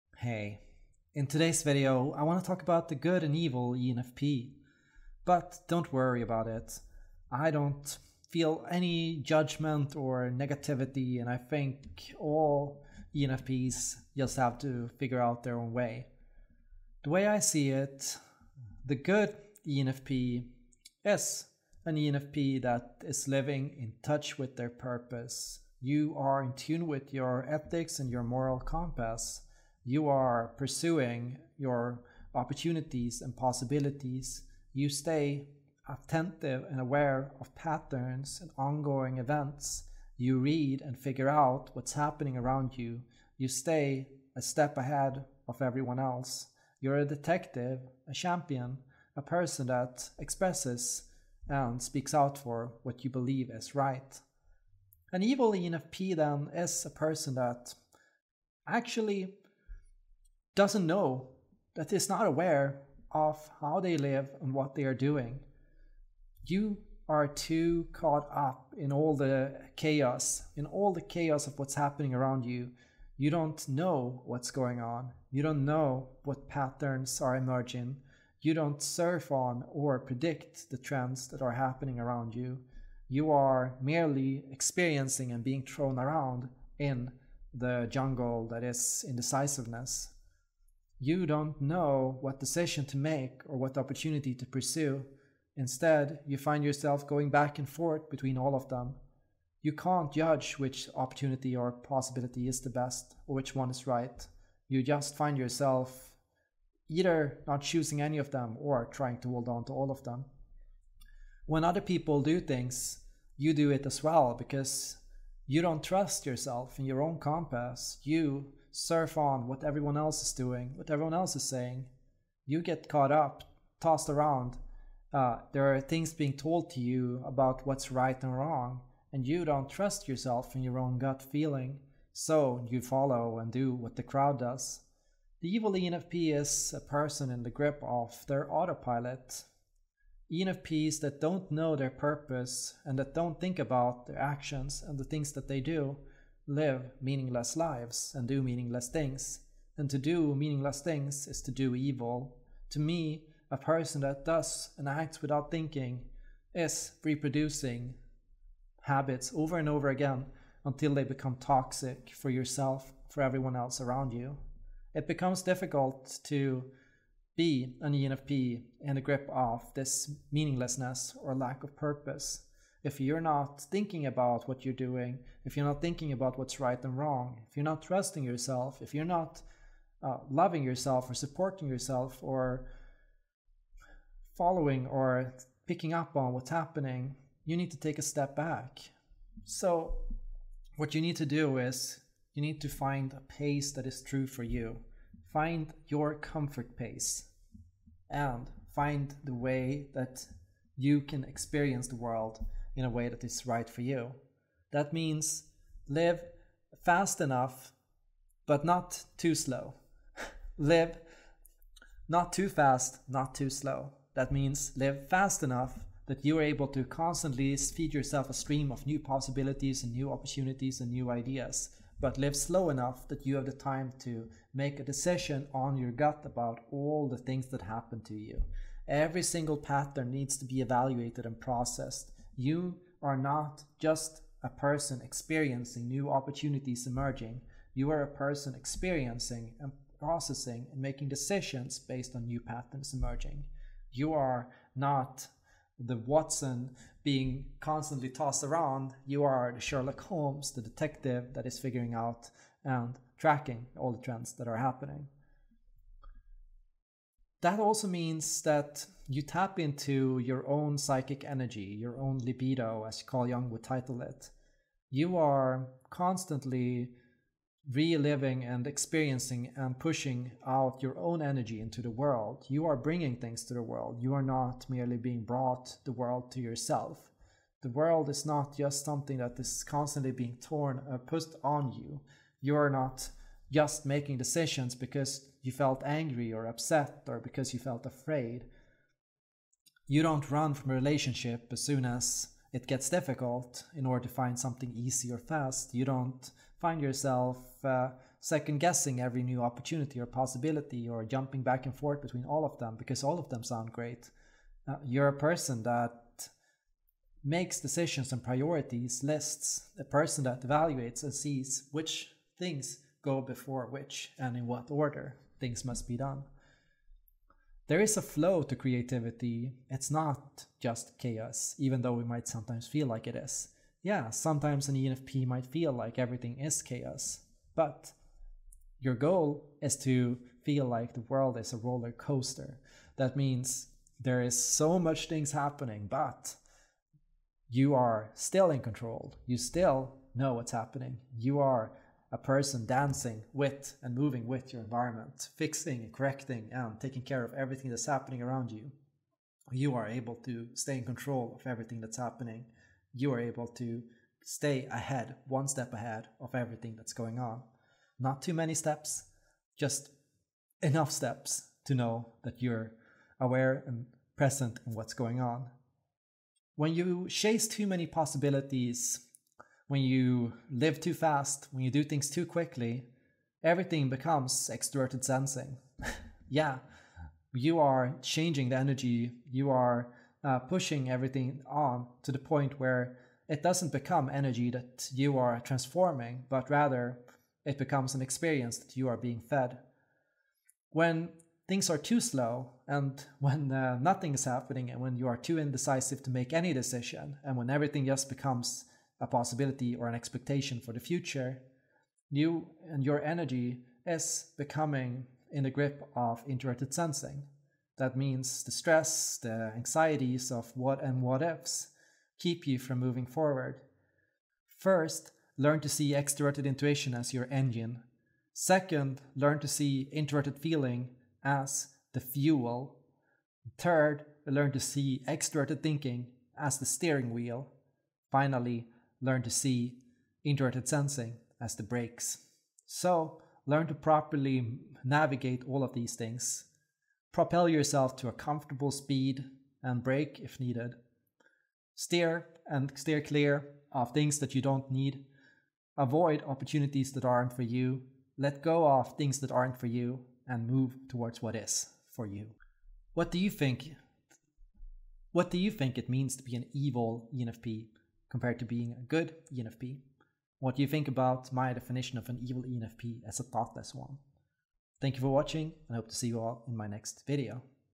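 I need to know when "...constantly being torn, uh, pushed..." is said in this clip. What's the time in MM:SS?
04:39.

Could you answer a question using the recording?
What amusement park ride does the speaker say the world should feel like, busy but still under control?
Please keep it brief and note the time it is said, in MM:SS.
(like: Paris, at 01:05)
Roller coaster, at 05:31.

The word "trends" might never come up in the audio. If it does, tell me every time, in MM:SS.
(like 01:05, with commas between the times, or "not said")
01:20, 04:14.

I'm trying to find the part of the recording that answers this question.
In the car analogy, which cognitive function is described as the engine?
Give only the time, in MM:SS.
06:55.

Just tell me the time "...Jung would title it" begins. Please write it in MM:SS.
04:23.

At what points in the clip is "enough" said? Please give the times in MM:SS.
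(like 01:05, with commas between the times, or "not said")
03:27, 03:35, 03:42, 06:00.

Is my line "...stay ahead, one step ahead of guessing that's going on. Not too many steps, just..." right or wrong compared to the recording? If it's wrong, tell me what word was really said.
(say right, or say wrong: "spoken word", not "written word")
wrong: "everything", not "guessing".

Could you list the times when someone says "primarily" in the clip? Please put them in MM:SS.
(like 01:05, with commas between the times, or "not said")
not said.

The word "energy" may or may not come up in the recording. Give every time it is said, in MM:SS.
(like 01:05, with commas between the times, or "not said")
04:21, 04:31, 06:18, 06:24, 06:43.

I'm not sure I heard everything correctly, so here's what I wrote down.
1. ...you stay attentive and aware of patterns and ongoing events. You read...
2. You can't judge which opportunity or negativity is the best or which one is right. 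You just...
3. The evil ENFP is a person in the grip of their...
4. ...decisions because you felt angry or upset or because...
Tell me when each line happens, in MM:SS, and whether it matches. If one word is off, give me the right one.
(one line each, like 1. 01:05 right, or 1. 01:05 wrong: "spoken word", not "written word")
1. 00:34 right
2. 01:39 wrong: "possibility", not "negativity"
3. 02:15 right
4. 04:44 right.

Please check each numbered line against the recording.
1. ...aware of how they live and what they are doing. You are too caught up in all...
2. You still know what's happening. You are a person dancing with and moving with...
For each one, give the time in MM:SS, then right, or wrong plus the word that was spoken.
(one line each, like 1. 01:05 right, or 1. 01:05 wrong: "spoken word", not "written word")
1. 01:02 right
2. 05:39 right.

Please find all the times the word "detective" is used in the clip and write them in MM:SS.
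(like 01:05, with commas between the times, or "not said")
00:47, 04:10.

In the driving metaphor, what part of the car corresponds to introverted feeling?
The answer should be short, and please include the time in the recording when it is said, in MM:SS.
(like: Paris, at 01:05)
The fuel, at 07:01.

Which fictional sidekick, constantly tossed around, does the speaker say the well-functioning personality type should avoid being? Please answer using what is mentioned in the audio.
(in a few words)
Watson.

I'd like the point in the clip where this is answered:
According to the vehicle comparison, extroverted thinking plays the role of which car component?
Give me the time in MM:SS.
07:06.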